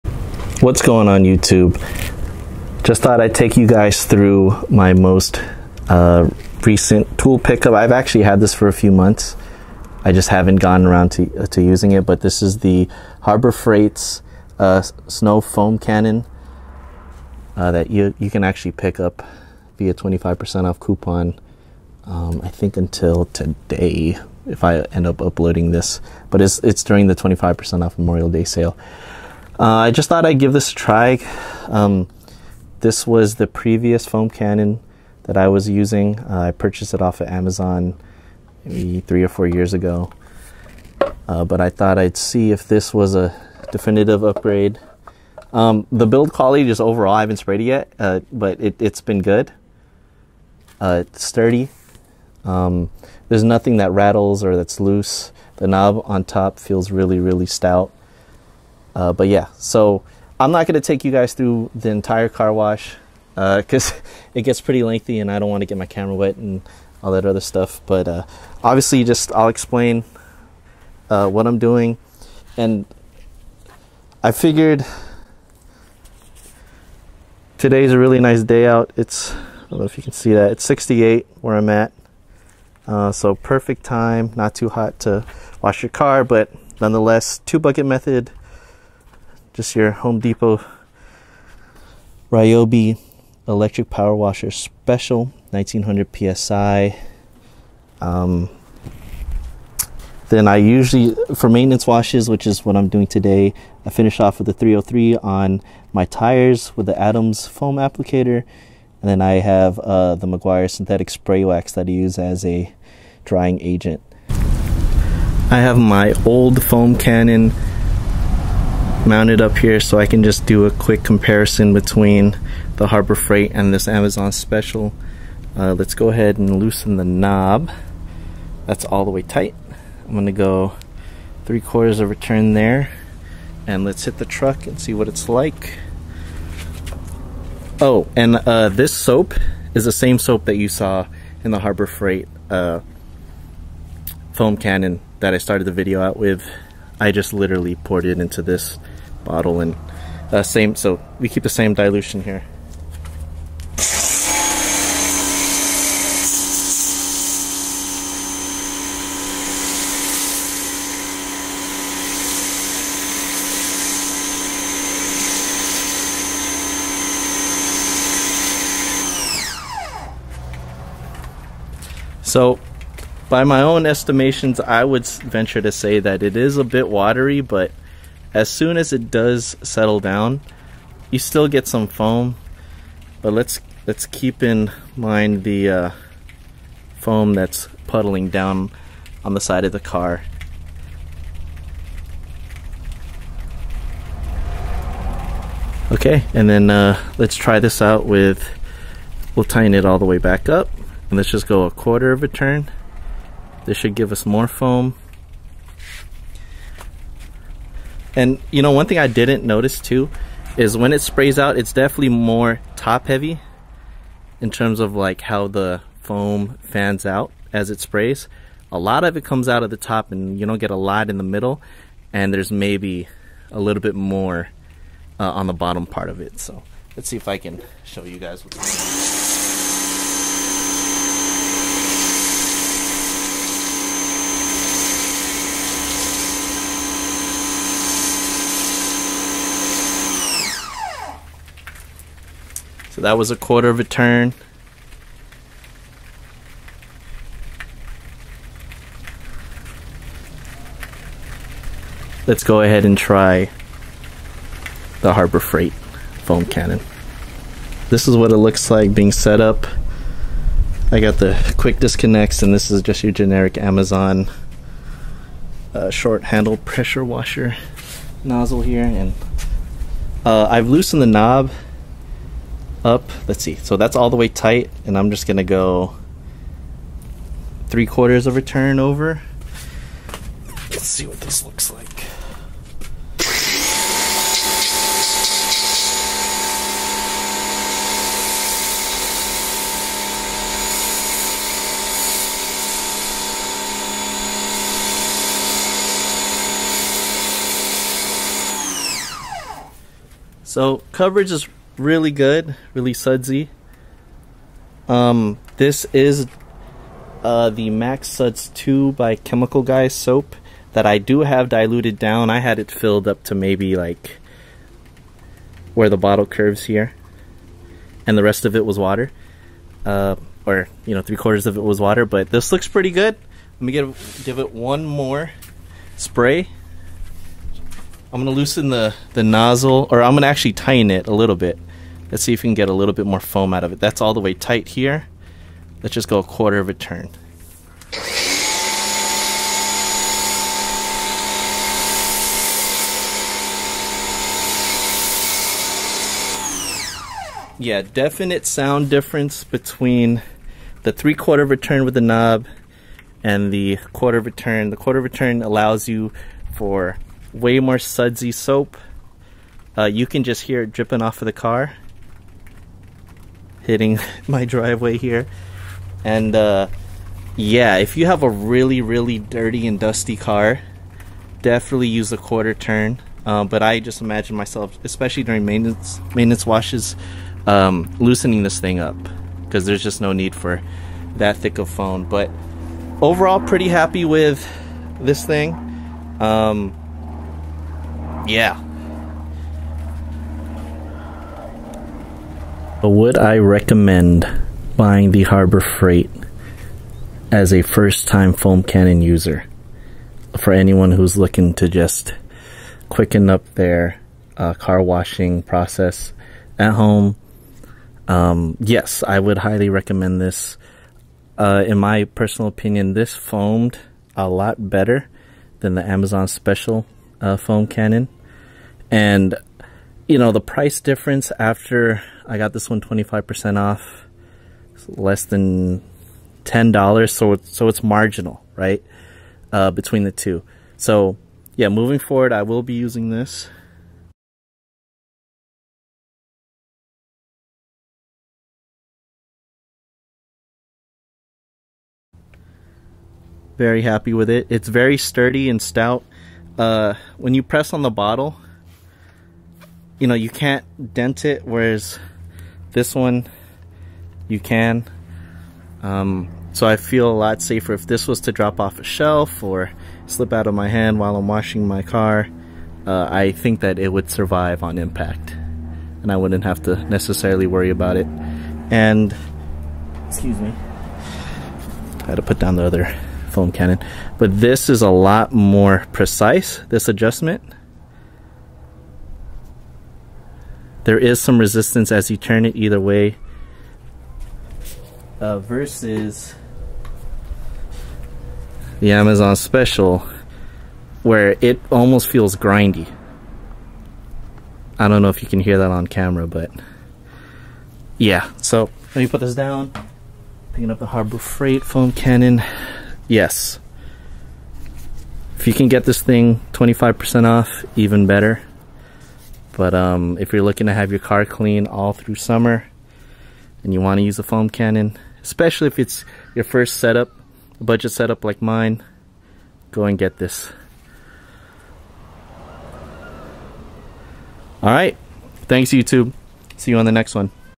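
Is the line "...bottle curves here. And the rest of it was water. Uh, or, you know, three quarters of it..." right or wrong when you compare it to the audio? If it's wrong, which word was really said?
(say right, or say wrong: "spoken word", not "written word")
right.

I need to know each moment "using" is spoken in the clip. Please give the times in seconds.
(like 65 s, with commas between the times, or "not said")
11 s, 35 s, 432 s.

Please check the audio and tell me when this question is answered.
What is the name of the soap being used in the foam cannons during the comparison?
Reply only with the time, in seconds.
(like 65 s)
307 s.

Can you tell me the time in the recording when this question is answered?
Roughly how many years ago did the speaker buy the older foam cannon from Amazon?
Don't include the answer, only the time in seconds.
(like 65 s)
39 s.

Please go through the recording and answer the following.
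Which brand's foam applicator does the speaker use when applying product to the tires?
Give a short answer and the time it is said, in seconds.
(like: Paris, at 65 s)
Adams, at 106 s.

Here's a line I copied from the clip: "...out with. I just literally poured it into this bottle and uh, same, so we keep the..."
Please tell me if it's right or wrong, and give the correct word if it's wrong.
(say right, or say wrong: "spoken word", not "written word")
right.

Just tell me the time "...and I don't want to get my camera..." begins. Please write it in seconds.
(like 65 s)
65 s.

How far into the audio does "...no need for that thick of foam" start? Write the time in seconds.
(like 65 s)
380 s.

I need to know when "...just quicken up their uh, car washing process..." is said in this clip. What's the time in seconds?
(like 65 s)
401 s.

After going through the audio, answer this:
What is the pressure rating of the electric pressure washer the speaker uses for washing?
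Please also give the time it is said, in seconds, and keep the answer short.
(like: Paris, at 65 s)
1900 psi, at 95 s.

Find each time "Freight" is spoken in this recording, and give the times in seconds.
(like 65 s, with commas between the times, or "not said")
13 s, 123 s, 141 s, 255 s, 395 s, 501 s.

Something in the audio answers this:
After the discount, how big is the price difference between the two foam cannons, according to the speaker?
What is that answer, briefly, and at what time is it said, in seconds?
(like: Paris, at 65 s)
less than $10, at 424 s.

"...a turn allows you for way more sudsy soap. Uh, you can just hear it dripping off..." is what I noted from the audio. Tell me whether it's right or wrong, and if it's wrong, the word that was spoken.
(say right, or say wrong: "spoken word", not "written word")
right.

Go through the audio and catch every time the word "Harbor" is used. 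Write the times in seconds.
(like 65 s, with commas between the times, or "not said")
13 s, 122 s, 141 s, 255 s, 395 s, 500 s.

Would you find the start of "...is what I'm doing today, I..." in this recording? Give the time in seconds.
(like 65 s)
102 s.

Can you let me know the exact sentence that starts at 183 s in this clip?
But let's let's keep in mind the uh, foam that's puddling down on the side of the car.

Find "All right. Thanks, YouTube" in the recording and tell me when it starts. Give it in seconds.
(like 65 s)
524 s.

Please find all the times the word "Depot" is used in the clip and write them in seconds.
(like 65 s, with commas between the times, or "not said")
90 s.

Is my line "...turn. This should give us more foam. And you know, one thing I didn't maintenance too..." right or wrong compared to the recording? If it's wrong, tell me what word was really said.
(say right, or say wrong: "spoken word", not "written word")
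wrong: "notice", not "maintenance".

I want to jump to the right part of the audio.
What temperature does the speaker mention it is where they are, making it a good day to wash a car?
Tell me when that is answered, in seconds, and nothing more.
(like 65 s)
80 s.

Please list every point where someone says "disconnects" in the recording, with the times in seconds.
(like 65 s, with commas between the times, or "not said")
261 s.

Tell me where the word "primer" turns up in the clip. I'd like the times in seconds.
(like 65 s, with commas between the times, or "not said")
not said.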